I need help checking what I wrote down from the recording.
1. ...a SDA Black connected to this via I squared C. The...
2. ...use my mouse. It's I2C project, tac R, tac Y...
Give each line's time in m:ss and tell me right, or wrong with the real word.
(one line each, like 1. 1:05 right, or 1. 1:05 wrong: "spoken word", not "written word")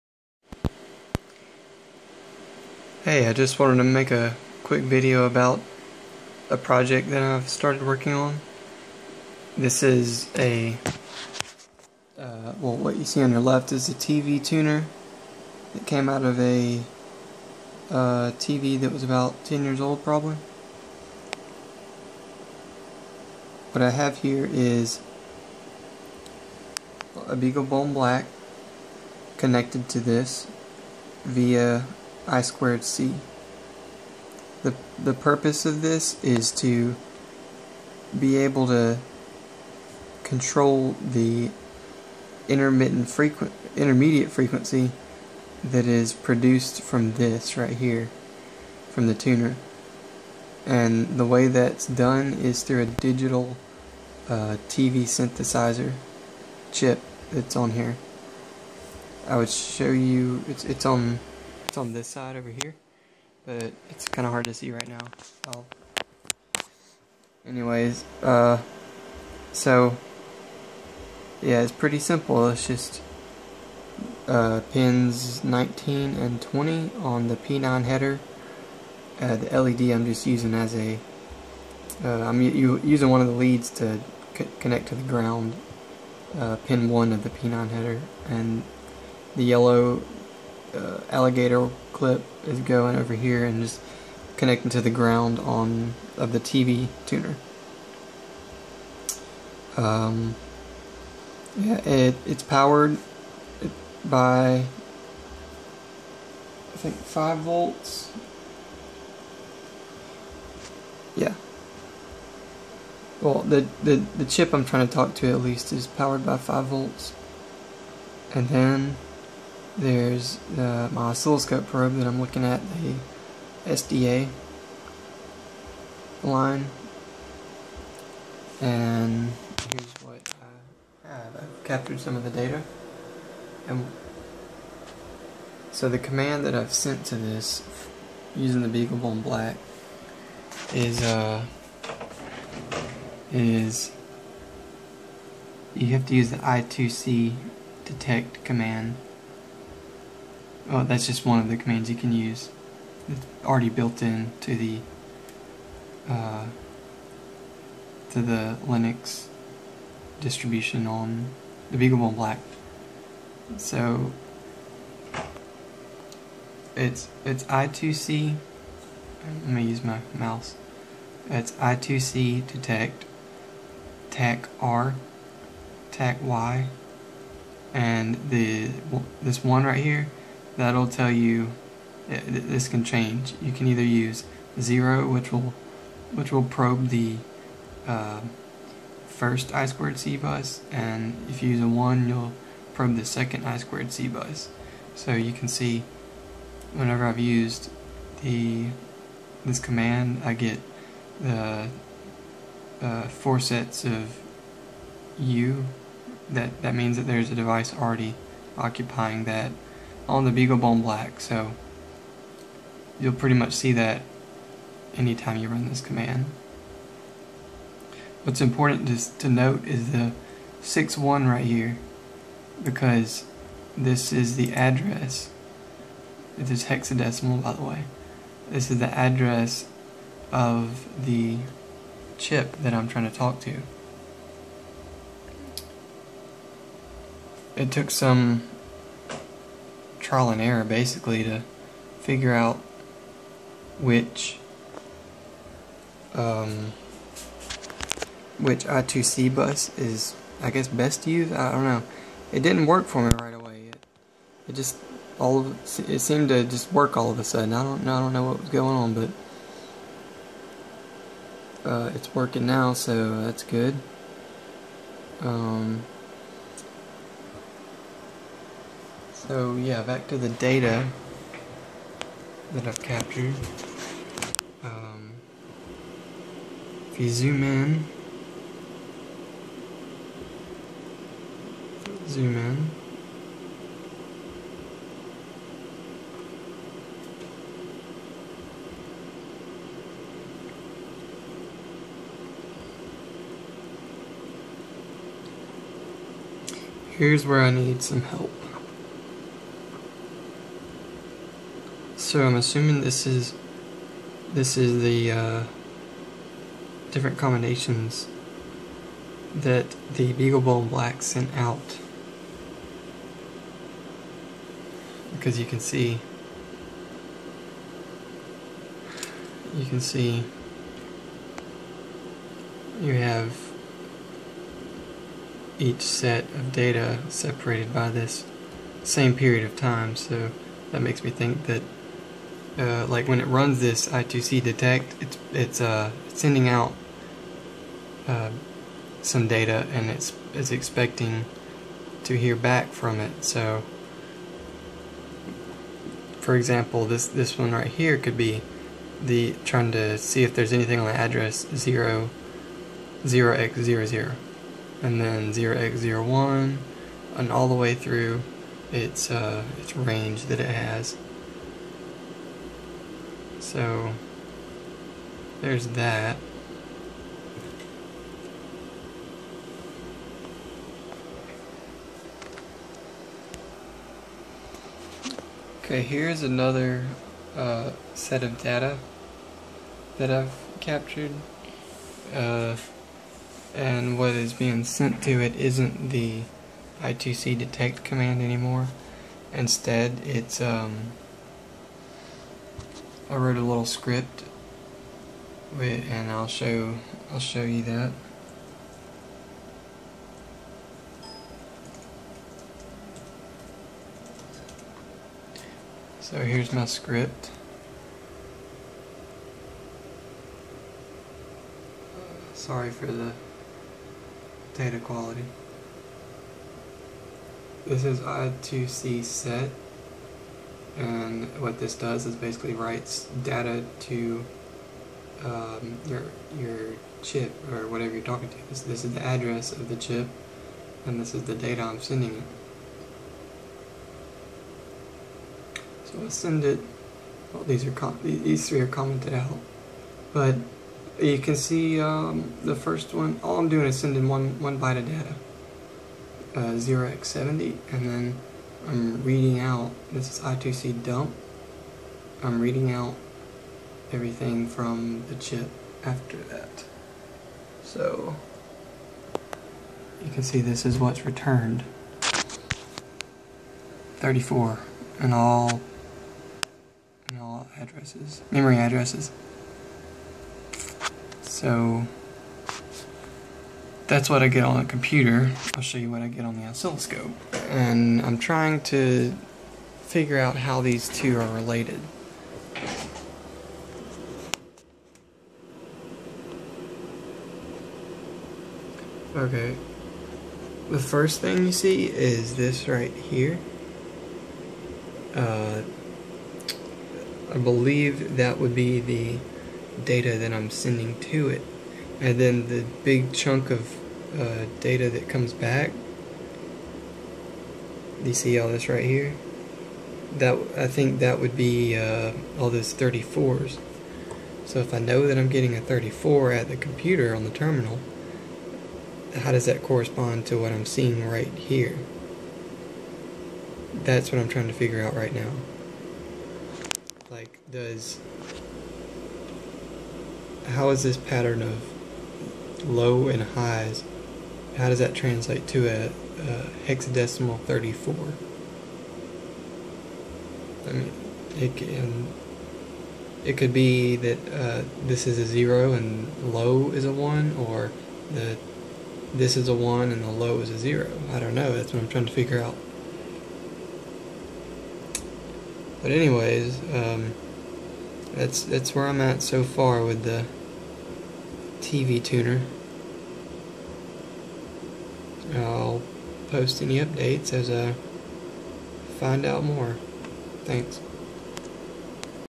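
1. 0:27 wrong: "BeagleBone", not "SDA"
2. 2:49 wrong: "detect", not "project".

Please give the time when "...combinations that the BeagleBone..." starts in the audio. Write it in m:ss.
5:07.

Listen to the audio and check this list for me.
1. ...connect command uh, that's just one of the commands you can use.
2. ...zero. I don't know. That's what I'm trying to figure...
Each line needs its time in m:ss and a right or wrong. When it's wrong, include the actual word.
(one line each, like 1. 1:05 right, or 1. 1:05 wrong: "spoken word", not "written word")
1. 2:27 wrong: "detect", not "connect"
2. 9:10 right.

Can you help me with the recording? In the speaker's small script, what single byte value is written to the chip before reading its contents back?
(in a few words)
0x70.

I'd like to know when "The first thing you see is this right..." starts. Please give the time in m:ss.
8:10.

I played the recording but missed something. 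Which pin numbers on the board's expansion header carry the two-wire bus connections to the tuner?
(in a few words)
19 and 20.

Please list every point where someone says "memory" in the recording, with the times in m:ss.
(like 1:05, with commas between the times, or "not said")
7:48.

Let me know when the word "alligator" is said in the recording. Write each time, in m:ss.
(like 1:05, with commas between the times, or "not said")
1:31.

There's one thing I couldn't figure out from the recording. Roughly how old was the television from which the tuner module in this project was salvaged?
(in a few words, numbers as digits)
about 10 years.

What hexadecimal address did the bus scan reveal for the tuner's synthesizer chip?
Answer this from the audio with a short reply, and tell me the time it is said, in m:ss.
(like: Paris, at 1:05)
0x61, at 3:40.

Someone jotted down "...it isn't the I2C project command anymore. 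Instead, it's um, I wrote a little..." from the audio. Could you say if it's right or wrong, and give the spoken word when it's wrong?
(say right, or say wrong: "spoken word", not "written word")
wrong: "detect", not "project".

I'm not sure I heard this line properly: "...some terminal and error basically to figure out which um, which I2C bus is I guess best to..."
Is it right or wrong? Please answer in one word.
wrong.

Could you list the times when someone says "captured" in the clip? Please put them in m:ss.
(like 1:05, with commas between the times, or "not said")
2:11, 4:32, 6:20.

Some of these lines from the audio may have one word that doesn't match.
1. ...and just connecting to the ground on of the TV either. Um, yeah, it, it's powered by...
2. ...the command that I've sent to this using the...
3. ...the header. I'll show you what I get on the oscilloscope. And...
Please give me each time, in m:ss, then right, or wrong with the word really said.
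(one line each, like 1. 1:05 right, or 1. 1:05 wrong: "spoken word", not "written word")
1. 1:33 wrong: "tuner", not "either"
2. 2:15 right
3. 7:54 wrong: "computer", not "header".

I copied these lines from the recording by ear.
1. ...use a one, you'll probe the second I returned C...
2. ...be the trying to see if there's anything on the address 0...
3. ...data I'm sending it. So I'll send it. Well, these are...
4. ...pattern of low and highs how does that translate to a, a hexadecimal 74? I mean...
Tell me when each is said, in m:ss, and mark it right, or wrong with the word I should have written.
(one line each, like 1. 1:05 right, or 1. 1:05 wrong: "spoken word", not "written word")
1. 3:11 wrong: "squared", not "returned"
2. 5:48 right
3. 7:11 right
4. 8:50 wrong: "34", not "74".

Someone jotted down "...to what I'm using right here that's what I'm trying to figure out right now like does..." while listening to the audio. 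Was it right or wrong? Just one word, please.
wrong.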